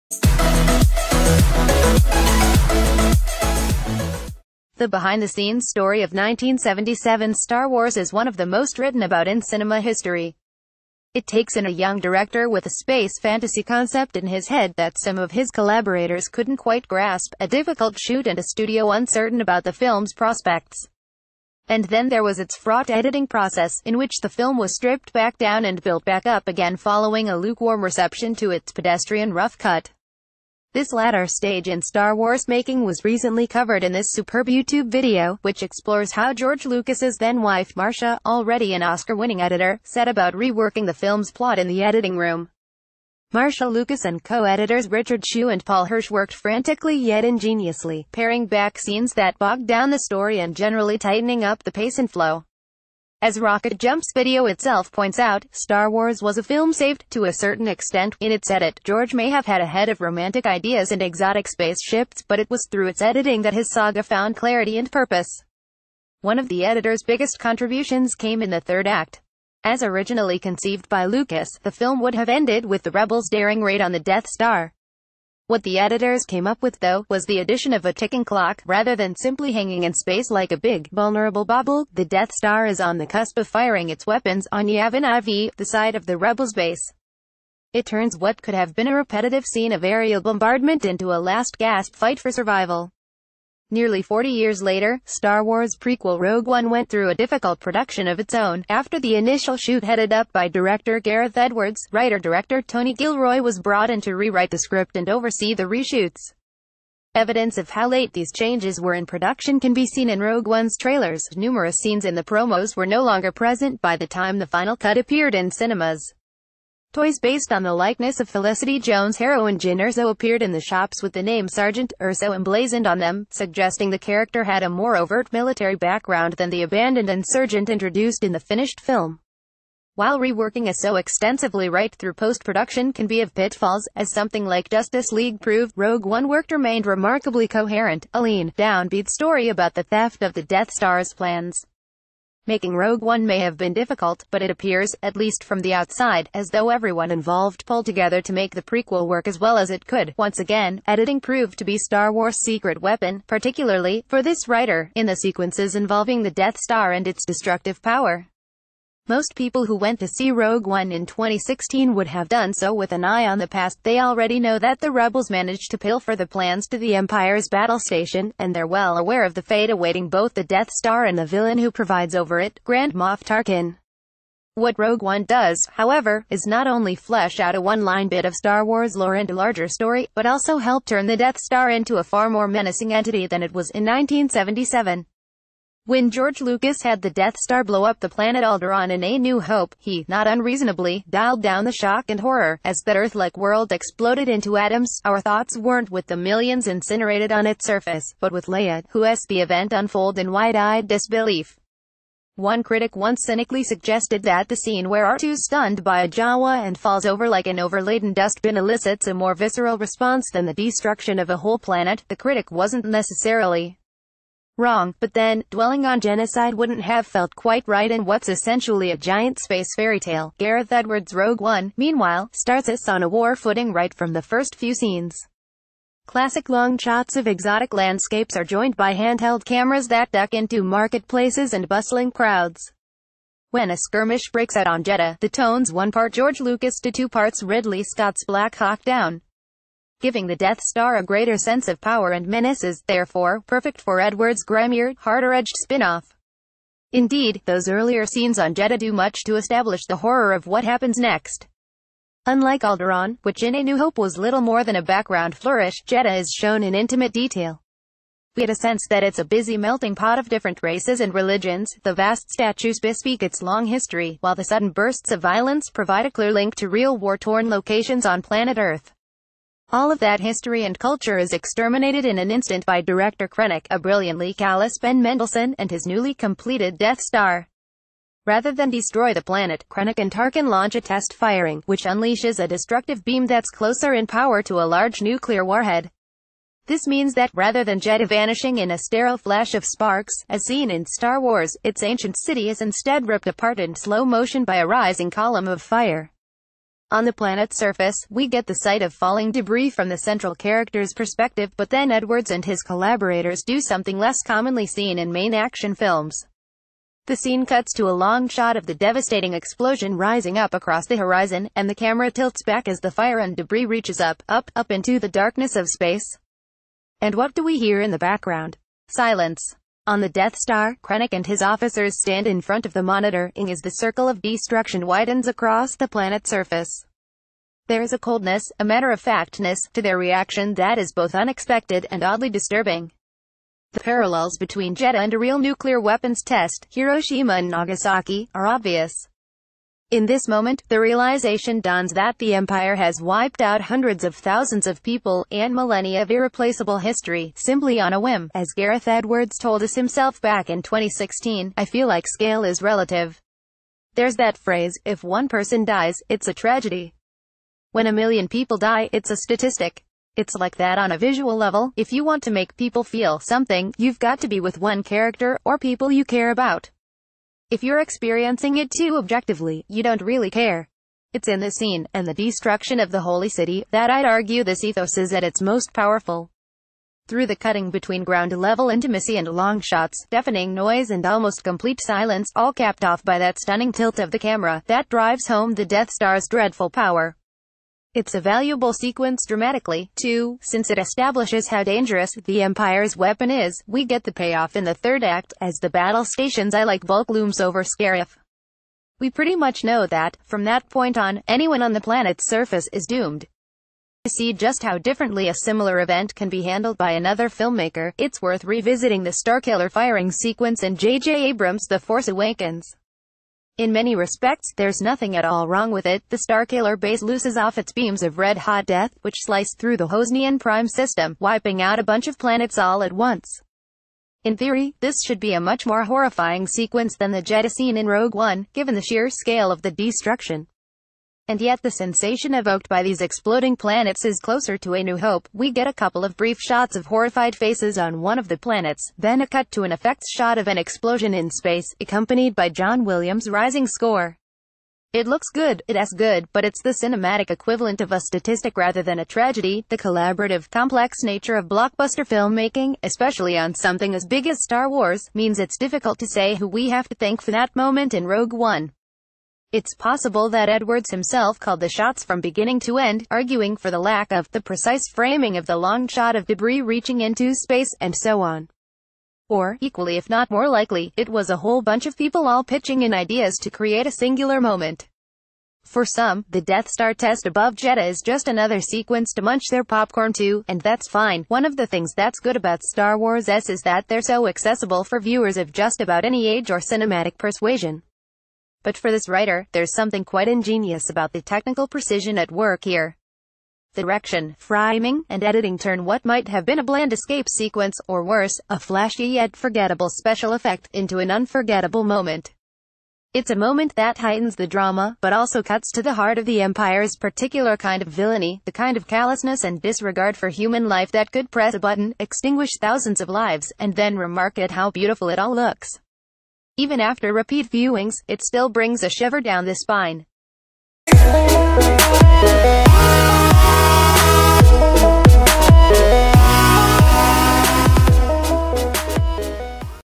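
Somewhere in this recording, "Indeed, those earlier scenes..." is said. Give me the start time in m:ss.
4:06.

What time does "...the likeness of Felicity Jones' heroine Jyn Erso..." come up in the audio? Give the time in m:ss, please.
1:57.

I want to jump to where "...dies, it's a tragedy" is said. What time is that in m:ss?
5:55.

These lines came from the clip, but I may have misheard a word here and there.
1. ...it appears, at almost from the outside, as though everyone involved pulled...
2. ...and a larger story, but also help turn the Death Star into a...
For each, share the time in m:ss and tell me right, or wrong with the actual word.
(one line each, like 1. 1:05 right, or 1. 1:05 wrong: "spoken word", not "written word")
1. 2:24 wrong: "least", not "almost"
2. 2:59 right.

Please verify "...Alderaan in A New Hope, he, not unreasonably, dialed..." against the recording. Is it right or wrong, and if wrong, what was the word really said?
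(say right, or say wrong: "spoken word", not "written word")
right.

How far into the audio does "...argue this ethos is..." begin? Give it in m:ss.
6:14.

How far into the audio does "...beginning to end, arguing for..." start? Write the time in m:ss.
7:42.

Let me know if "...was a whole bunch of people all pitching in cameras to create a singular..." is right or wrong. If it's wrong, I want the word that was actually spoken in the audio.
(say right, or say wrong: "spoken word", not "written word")
wrong: "ideas", not "cameras".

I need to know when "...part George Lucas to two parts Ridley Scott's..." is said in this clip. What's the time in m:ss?
3:55.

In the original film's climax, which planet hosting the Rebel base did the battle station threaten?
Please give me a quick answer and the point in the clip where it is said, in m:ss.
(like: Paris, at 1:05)
Yavin IV, at 1:24.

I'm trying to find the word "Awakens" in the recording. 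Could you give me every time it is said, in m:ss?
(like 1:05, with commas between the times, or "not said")
6:52.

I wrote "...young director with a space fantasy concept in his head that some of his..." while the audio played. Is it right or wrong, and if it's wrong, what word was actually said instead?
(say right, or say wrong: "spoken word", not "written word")
right.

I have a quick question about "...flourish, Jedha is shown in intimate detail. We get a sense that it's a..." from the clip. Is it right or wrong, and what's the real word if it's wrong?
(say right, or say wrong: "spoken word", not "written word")
right.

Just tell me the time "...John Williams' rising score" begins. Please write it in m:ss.
7:22.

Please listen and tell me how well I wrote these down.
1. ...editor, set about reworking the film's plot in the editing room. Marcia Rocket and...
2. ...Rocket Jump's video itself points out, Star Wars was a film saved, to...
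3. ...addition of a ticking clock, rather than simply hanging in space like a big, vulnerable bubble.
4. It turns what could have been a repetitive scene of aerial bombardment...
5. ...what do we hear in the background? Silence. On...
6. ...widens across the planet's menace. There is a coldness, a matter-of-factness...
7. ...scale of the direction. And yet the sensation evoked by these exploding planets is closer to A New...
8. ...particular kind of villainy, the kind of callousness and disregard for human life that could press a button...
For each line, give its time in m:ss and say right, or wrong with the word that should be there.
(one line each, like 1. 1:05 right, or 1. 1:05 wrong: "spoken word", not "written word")
1. 0:39 wrong: "Lucas", not "Rocket"
2. 0:53 right
3. 1:17 right
4. 1:27 right
5. 5:17 right
6. 5:24 wrong: "surface", not "menace"
7. 7:09 wrong: "destruction", not "direction"
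8. 8:26 right.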